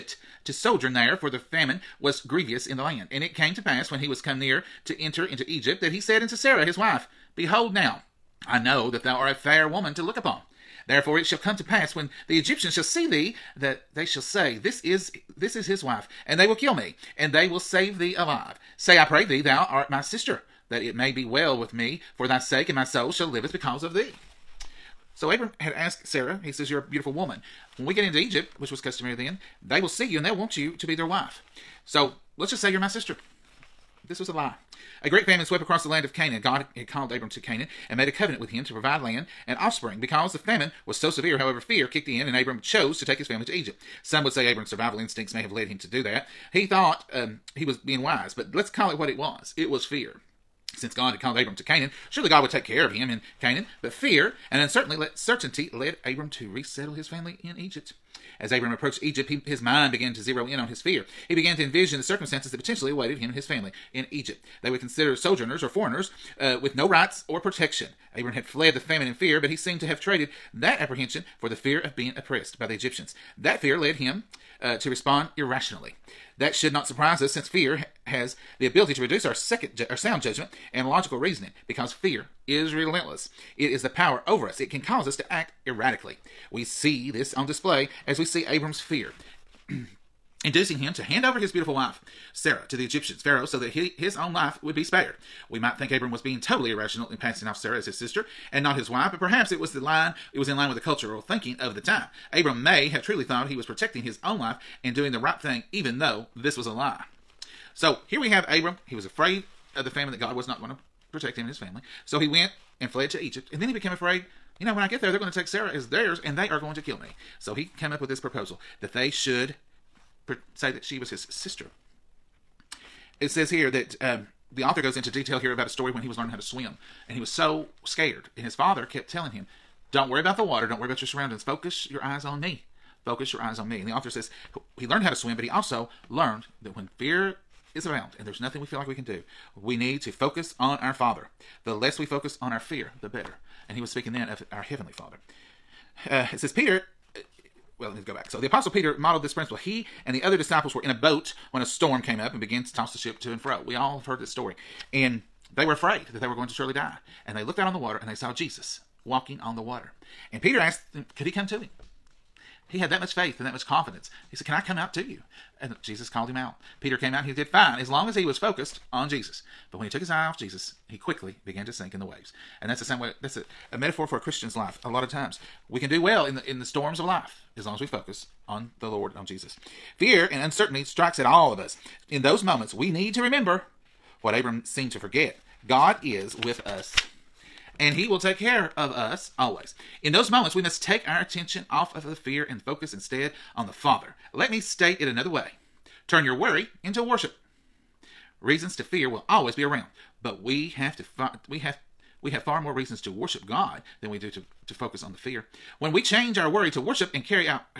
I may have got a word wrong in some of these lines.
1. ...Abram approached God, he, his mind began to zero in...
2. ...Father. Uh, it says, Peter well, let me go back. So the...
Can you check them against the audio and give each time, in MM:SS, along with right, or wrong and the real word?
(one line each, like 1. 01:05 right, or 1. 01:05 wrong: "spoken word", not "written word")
1. 00:58 wrong: "Egypt", not "God"
2. 02:24 right.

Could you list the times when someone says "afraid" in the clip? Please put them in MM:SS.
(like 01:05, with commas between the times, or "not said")
01:49, 01:53, 02:35.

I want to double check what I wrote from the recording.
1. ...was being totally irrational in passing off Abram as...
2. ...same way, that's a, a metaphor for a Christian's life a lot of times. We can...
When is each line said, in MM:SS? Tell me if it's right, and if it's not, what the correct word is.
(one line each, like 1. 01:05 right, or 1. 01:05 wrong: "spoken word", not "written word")
1. 01:36 wrong: "Sarah", not "Abram"
2. 02:52 right.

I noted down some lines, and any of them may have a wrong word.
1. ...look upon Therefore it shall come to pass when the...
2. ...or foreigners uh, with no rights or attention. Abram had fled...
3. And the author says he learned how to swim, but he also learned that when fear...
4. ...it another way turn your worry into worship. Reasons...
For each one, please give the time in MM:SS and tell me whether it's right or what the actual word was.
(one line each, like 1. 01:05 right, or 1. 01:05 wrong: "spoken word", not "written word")
1. 00:10 right
2. 01:05 wrong: "protection", not "attention"
3. 02:13 right
4. 03:14 right.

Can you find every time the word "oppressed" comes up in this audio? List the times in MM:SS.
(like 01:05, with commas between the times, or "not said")
01:12.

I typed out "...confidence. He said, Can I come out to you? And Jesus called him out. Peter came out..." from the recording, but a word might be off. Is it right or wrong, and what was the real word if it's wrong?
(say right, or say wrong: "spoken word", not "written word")
right.